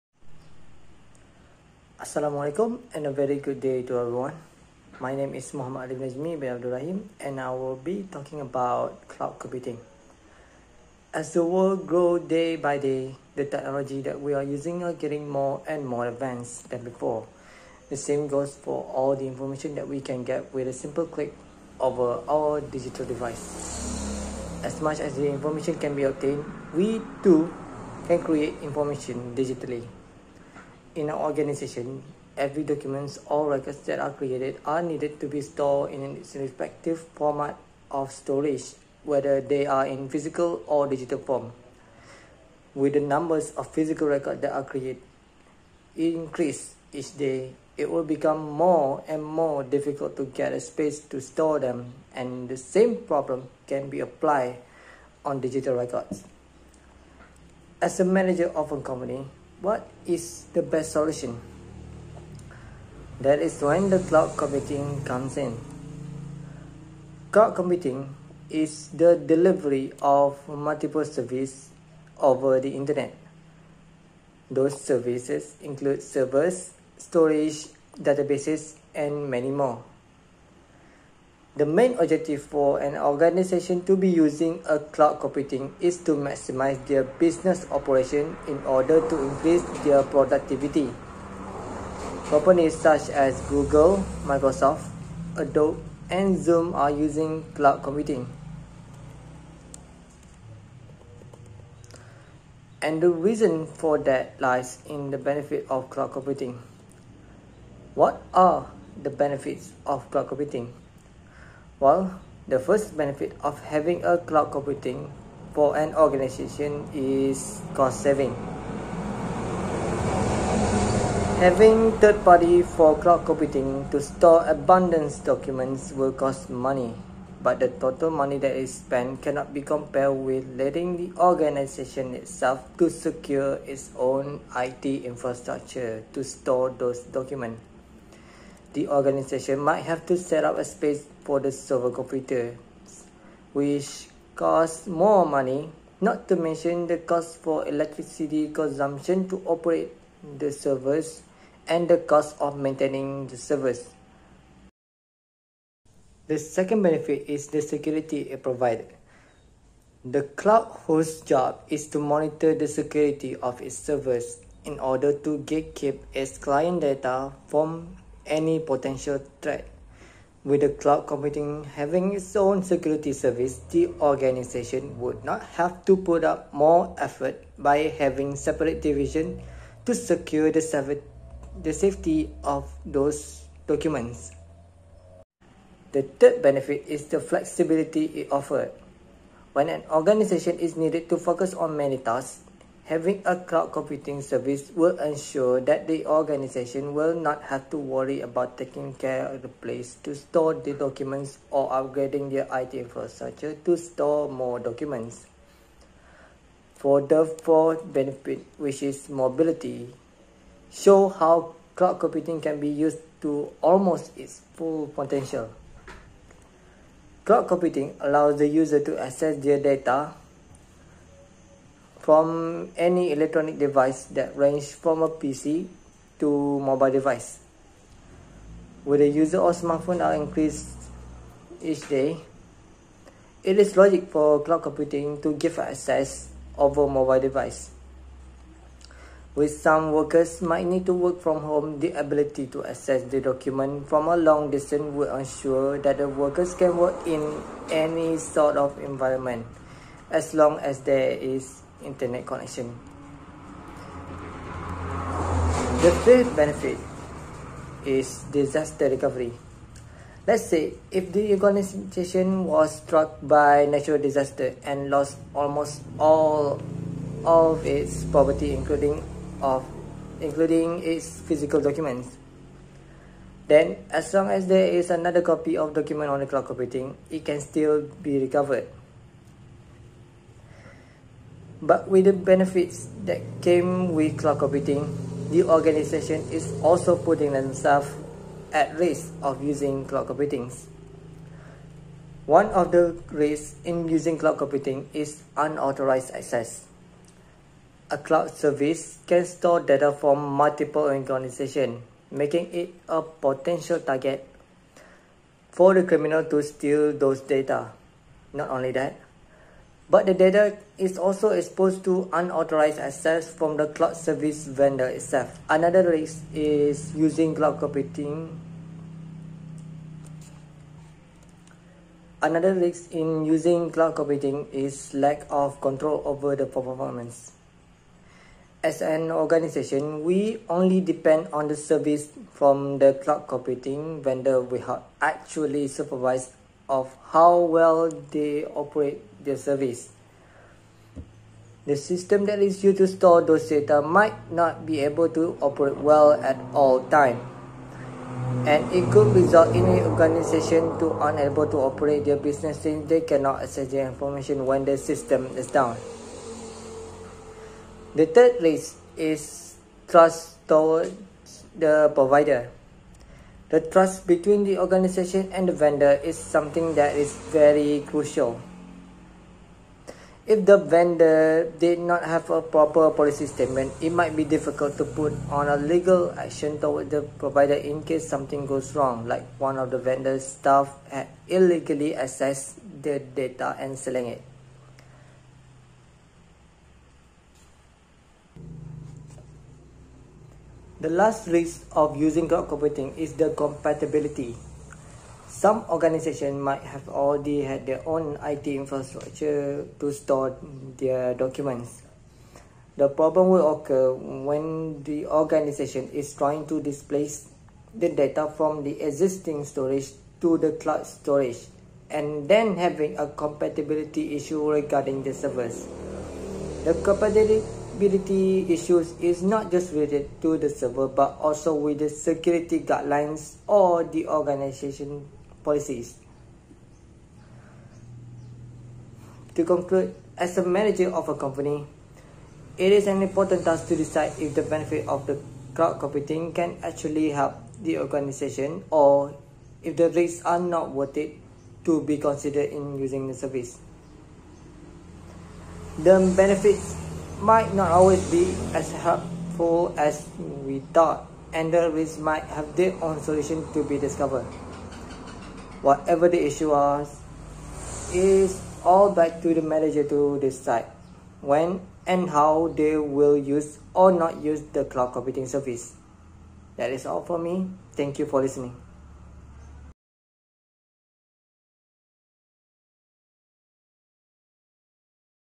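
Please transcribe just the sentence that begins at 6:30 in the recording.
The last risk of using cloud computing is the compatibility.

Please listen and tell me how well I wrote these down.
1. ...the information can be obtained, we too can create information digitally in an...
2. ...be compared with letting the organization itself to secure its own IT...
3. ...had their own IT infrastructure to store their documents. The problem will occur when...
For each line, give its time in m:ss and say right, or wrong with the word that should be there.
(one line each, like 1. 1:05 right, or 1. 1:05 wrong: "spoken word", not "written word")
1. 0:25 right
2. 2:09 right
3. 6:37 right.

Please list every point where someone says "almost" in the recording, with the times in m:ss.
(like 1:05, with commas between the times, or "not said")
3:33, 4:25.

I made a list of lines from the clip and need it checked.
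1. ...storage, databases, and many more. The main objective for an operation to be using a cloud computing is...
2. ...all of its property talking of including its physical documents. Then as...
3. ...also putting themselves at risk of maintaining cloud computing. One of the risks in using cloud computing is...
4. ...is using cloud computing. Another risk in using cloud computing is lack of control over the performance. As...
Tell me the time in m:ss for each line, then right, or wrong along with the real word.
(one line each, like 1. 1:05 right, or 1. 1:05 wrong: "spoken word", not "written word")
1. 1:16 wrong: "organization", not "operation"
2. 4:25 wrong: "including", not "talking"
3. 4:46 wrong: "using", not "maintaining"
4. 5:16 right.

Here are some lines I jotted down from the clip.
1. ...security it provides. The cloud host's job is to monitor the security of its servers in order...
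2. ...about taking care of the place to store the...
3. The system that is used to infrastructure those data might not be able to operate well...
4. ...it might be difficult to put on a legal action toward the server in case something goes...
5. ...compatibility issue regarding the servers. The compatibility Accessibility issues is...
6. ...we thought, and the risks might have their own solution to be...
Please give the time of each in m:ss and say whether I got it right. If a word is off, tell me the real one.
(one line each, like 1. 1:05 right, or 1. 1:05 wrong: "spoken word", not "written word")
1. 2:37 right
2. 3:18 right
3. 5:41 wrong: "store", not "infrastructure"
4. 6:13 wrong: "provider", not "server"
5. 6:53 right
6. 7:30 right.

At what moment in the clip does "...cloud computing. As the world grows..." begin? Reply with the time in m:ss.
0:09.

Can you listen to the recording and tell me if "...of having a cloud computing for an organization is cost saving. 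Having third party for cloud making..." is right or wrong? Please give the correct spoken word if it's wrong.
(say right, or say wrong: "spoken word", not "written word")
wrong: "computing", not "making".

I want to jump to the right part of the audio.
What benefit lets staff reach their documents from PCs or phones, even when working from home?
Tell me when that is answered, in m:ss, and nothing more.
3:29.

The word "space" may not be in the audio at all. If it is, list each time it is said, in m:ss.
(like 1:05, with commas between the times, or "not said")
0:50, 2:20.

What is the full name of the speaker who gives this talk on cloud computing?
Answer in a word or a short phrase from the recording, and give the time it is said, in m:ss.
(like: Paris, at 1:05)
Muhammad Alif Najmi bin Abdul Rahim, at 0:05.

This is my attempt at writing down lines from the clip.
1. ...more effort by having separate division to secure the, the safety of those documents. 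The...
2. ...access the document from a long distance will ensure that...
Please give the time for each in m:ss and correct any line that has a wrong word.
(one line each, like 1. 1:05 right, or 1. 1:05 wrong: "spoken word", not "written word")
1. 2:56 right
2. 4:02 right.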